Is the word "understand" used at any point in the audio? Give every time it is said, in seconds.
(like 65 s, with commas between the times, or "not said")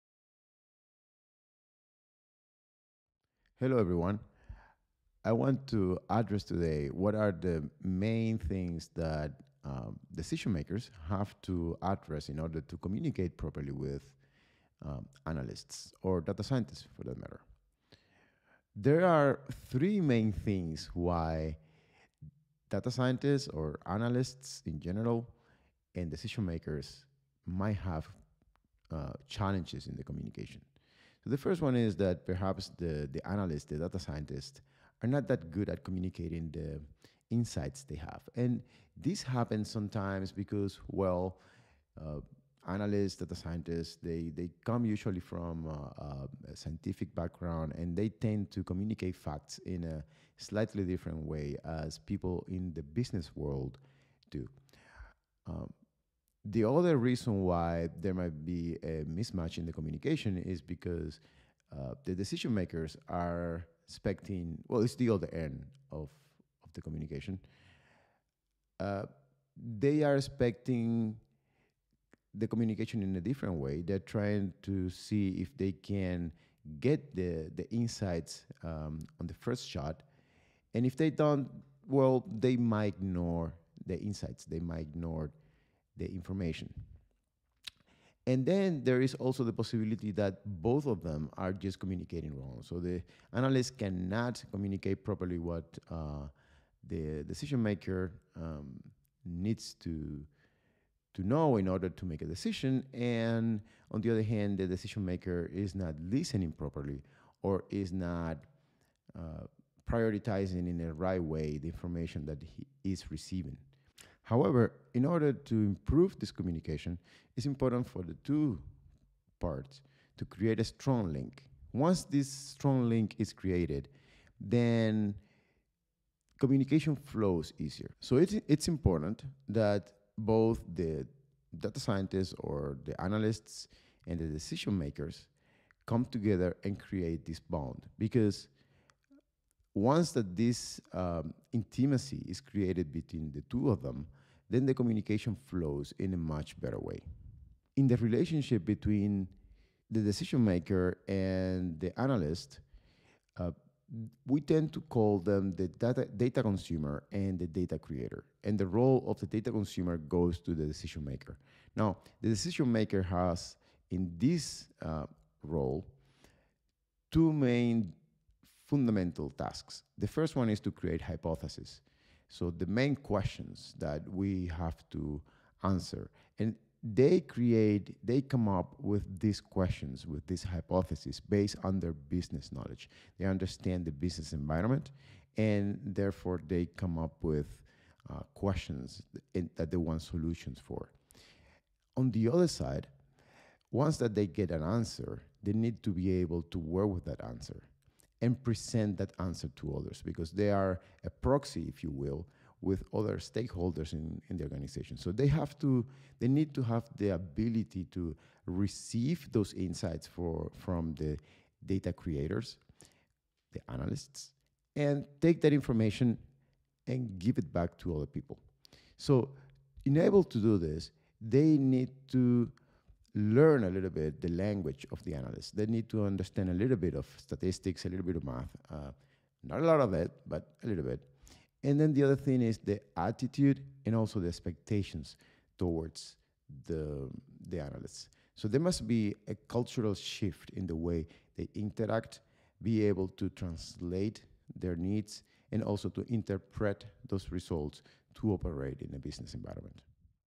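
183 s, 226 s.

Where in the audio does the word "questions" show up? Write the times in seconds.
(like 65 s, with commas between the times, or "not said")
172 s, 179 s, 188 s.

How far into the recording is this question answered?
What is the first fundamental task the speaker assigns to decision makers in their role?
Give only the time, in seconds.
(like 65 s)
170 s.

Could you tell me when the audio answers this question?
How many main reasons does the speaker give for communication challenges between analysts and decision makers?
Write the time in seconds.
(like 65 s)
19 s.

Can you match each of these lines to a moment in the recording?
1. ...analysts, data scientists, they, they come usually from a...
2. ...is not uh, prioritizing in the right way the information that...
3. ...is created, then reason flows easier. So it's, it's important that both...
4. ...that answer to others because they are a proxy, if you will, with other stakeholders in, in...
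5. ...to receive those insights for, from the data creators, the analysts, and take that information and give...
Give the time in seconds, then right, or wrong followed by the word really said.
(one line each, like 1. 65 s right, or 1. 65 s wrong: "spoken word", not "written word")
1. 42 s right
2. 107 s right
3. 123 s wrong: "communication", not "reason"
4. 198 s right
5. 207 s right.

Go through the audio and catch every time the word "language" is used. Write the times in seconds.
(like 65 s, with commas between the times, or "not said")
224 s.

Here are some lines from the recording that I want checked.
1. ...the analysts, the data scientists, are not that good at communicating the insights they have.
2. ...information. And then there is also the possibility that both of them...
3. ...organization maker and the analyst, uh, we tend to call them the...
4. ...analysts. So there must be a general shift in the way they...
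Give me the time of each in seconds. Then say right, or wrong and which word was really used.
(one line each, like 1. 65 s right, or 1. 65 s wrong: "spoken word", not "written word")
1. 33 s right
2. 86 s right
3. 150 s wrong: "decision", not "organization"
4. 237 s wrong: "cultural", not "general".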